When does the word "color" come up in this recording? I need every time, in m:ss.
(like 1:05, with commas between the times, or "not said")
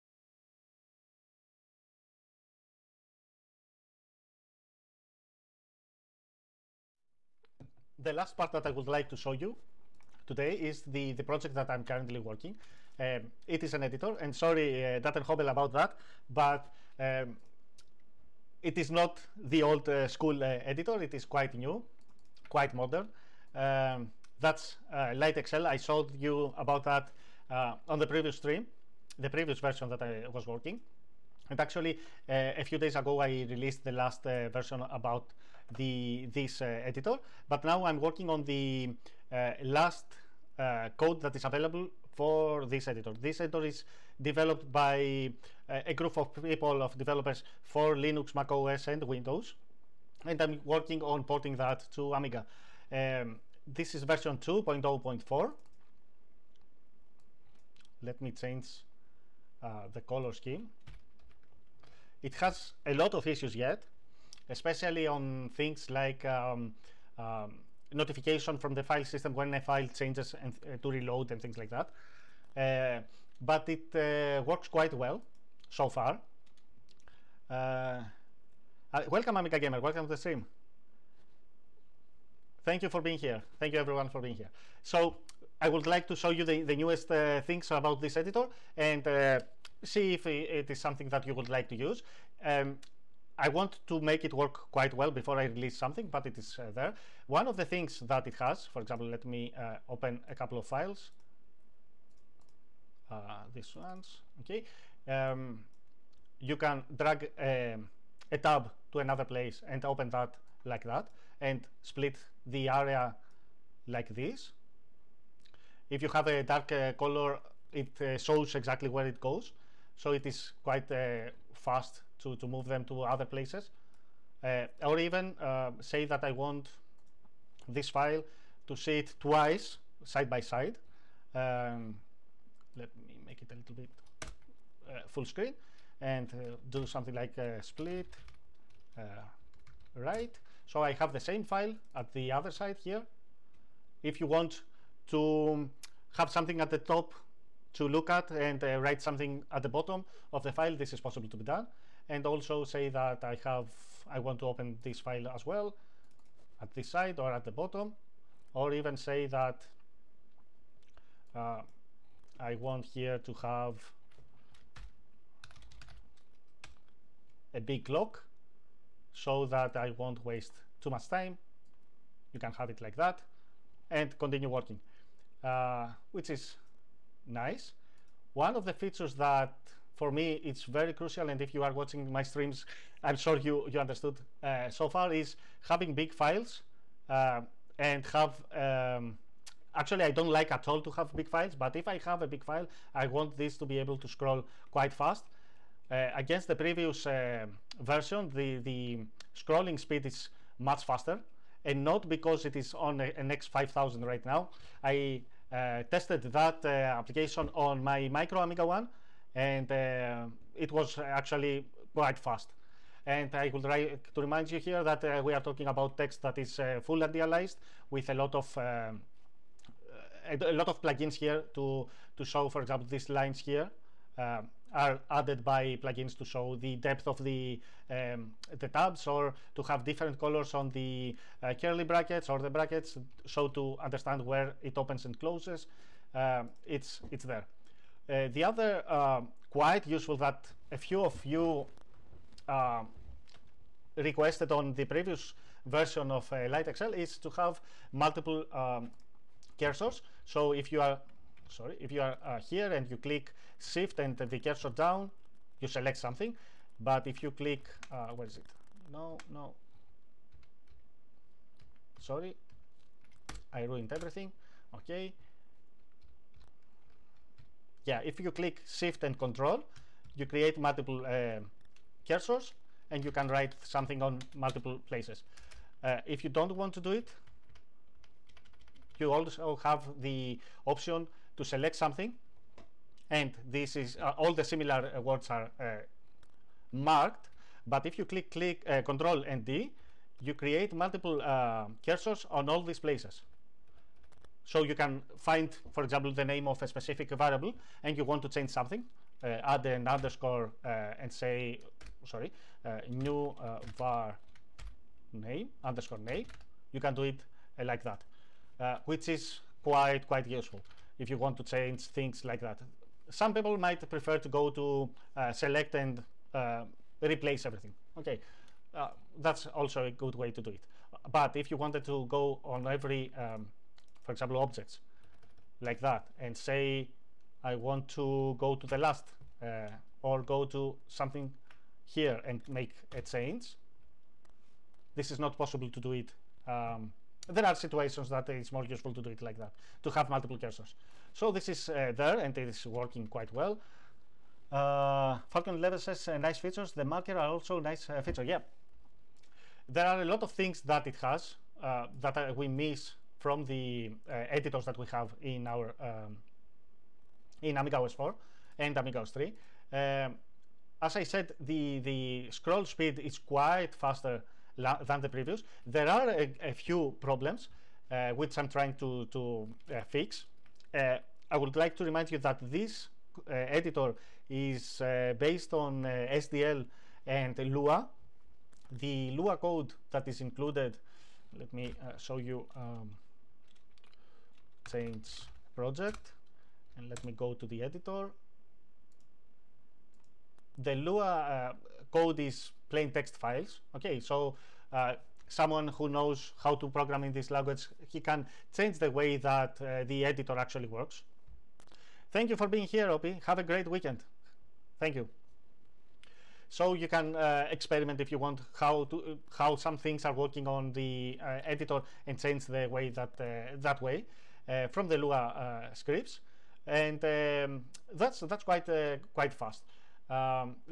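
0:59, 1:56, 3:50.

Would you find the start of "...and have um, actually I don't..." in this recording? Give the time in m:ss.
3:07.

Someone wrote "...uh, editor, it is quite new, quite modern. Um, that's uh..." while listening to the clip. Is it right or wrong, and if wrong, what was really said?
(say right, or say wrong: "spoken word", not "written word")
right.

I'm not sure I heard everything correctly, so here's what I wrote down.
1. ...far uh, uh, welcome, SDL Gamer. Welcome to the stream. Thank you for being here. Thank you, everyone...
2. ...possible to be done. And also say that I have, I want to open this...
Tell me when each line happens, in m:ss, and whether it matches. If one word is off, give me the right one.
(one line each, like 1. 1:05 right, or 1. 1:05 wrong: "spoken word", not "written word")
1. 1:15 wrong: "Amica", not "SDL"
2. 2:30 right.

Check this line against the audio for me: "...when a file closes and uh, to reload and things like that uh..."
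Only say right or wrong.
wrong.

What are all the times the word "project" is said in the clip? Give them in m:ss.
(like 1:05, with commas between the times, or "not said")
0:11, 6:25.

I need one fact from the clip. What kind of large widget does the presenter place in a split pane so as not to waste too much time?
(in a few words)
A big clock.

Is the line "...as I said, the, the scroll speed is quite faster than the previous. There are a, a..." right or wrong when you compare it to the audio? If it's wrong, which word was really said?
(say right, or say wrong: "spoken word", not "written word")
right.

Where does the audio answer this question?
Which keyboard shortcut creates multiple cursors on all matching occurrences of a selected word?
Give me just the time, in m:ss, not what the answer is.
4:48.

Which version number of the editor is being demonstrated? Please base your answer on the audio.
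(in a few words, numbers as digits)
2.0.4.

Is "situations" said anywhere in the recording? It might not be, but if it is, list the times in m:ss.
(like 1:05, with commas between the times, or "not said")
5:37.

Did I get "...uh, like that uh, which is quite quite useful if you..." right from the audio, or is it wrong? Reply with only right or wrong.
right.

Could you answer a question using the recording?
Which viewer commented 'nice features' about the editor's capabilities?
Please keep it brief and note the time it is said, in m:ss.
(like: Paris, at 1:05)
Falcon 11, at 5:45.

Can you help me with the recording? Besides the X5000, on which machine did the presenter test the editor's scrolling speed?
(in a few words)
Micro Amiga 1.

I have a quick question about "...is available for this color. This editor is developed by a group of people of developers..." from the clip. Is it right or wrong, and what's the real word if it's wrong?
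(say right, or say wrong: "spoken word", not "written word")
wrong: "editor", not "color".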